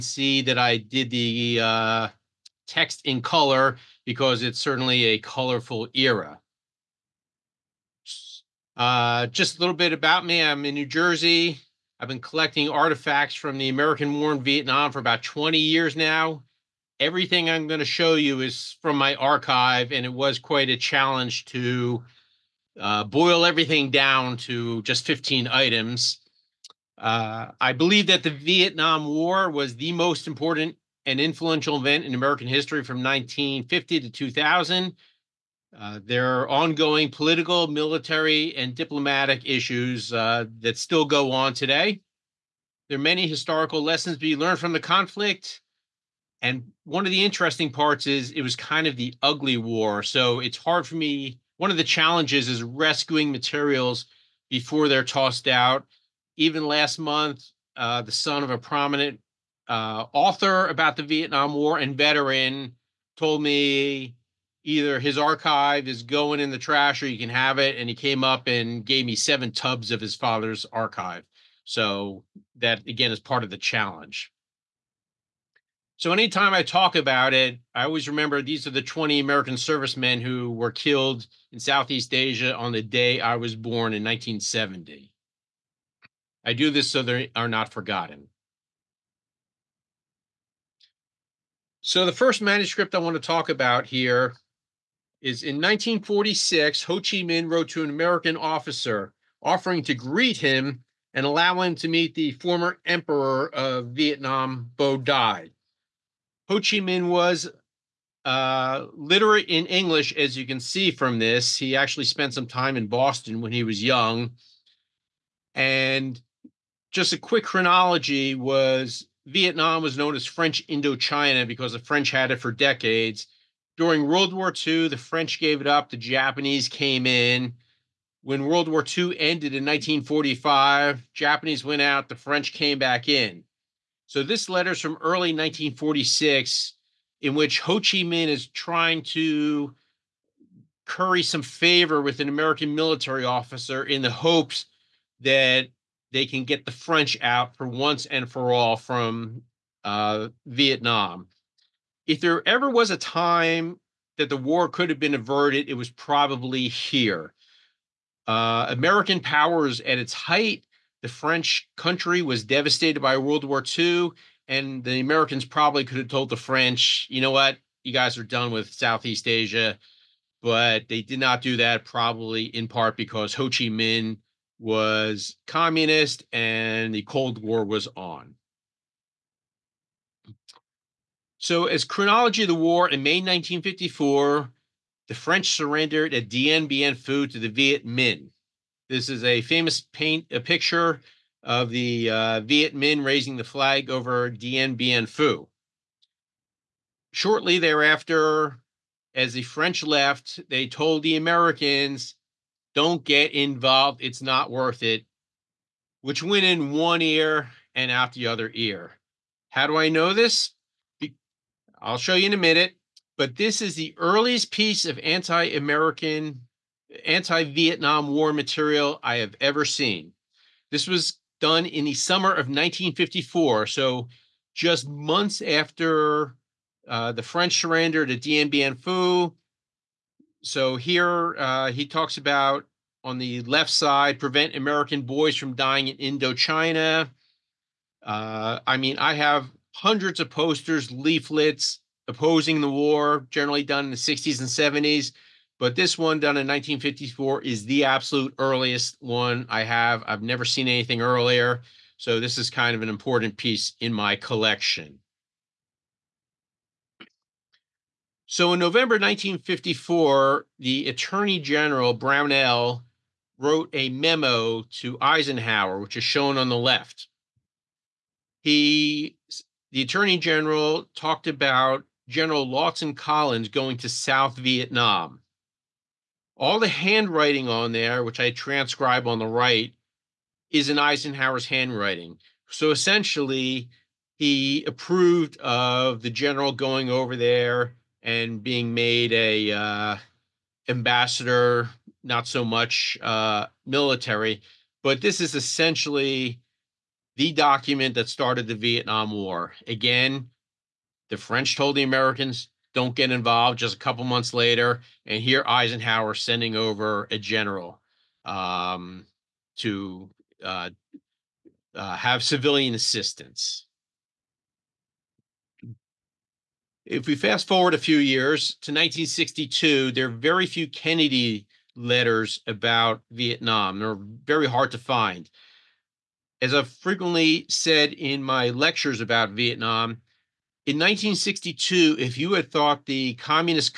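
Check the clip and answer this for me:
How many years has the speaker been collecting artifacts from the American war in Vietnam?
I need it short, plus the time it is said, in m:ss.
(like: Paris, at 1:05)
20 years, at 0:14.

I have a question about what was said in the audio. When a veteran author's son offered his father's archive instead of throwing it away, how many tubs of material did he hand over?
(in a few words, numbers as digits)
7.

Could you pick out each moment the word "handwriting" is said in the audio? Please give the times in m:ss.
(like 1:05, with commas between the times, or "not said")
4:36, 4:41.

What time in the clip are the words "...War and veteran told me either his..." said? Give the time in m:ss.
1:01.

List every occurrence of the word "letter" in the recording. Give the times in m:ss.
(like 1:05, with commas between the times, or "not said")
2:14, 5:21.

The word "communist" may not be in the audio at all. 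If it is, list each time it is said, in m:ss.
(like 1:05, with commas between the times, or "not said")
2:55, 5:33.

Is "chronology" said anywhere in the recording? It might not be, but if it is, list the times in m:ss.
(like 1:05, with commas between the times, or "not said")
1:57, 3:01.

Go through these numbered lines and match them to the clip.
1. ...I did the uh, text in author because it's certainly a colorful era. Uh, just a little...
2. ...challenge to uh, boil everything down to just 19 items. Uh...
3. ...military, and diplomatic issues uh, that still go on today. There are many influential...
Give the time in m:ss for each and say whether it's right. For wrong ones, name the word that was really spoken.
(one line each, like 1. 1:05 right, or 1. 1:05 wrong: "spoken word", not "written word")
1. 0:00 wrong: "color", not "author"
2. 0:20 wrong: "15", not "19"
3. 0:37 wrong: "historical", not "influential".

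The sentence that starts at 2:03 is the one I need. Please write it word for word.
During World War II, the French gave it up, the Japanese came in.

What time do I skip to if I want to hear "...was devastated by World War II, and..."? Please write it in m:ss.
2:42.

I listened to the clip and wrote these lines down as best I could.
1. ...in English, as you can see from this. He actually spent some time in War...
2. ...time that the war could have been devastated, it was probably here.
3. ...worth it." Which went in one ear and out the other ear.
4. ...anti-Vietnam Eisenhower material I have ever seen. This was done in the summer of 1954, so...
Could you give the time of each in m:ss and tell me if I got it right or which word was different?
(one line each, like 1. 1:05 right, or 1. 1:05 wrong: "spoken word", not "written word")
1. 1:49 wrong: "Boston", not "War"
2. 2:32 wrong: "averted", not "devastated"
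3. 3:24 right
4. 3:37 wrong: "War", not "Eisenhower".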